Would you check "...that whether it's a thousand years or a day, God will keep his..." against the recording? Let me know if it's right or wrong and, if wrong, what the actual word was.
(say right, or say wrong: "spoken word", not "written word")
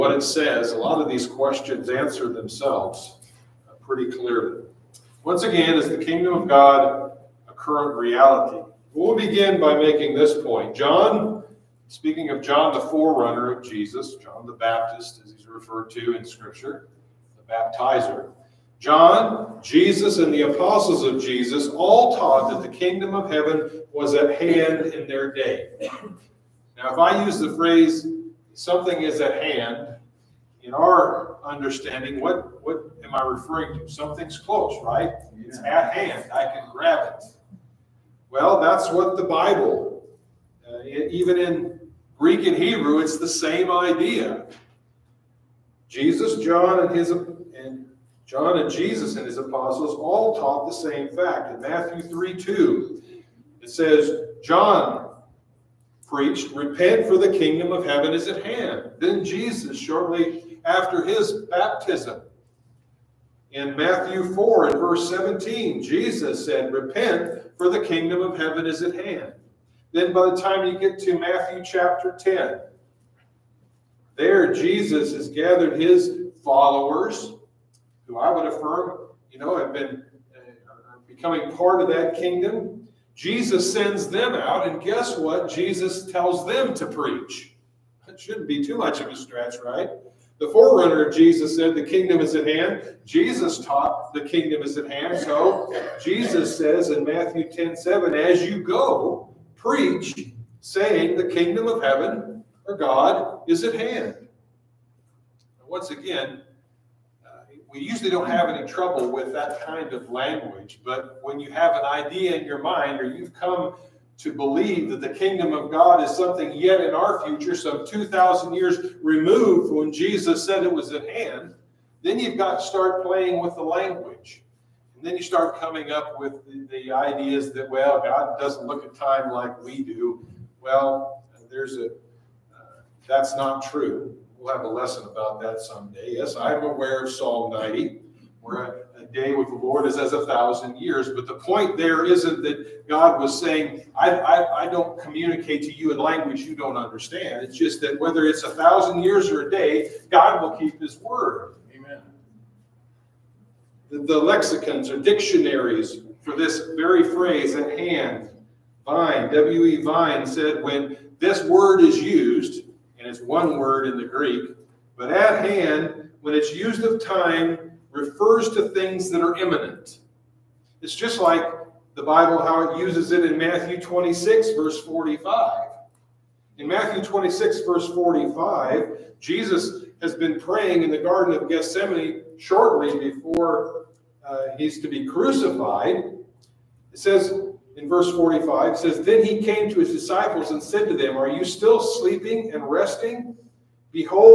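right.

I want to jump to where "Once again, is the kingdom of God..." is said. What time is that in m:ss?
0:05.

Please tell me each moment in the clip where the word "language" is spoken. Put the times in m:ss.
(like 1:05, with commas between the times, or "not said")
1:50, 2:03, 2:25.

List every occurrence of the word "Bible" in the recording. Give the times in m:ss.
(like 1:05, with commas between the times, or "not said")
0:39, 2:52.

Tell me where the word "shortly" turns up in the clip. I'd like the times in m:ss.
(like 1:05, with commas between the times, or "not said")
0:59, 3:02.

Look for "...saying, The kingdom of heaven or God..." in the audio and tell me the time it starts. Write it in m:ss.
1:40.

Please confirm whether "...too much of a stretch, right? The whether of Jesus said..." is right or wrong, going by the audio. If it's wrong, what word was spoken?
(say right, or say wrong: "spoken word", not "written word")
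wrong: "forerunner", not "whether".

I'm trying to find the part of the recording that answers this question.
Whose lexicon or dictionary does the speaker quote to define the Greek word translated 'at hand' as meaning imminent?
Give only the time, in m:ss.
2:39.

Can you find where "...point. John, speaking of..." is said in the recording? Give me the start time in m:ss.
0:10.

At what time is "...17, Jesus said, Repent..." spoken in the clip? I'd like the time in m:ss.
1:05.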